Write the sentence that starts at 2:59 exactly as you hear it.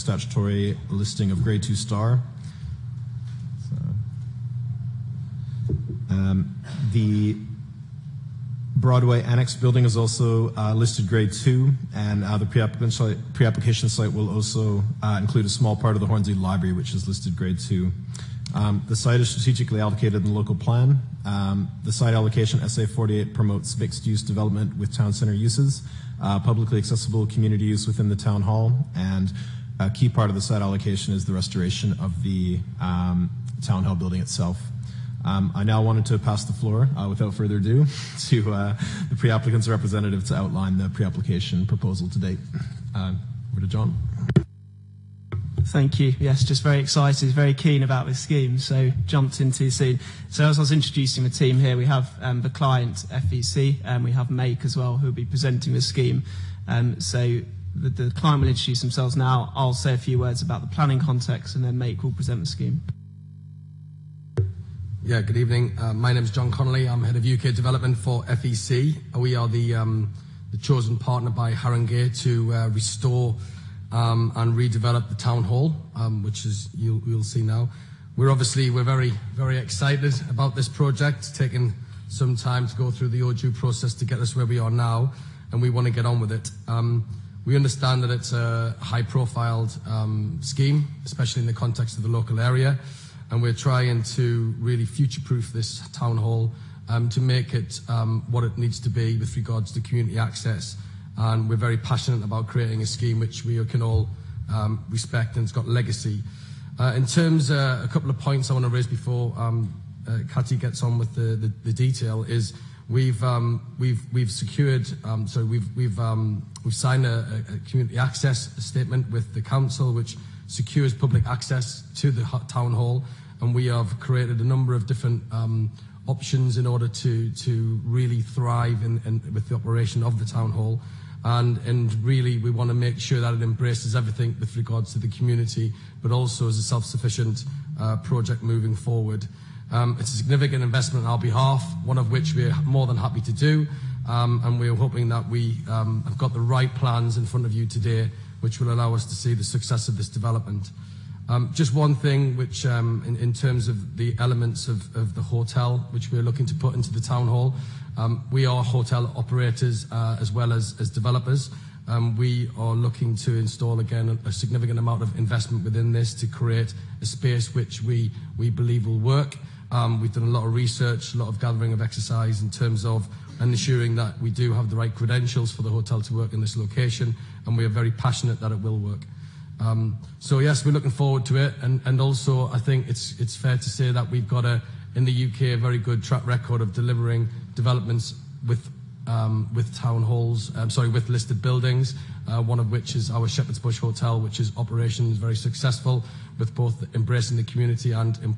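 Um, so yes, we're looking forward to it.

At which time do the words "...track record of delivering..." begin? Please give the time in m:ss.
3:06.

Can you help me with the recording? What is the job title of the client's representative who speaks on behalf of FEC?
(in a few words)
Head of UK development.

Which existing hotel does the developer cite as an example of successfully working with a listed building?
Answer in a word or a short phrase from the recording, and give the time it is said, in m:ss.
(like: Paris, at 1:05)
Shepherd's Bush Hotel, at 3:13.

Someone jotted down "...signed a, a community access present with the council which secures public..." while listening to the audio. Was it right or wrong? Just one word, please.
wrong.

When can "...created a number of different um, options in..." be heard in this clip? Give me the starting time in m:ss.
2:03.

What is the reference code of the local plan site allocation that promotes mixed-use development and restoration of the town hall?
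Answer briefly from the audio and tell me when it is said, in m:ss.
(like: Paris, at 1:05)
SA 48, at 0:22.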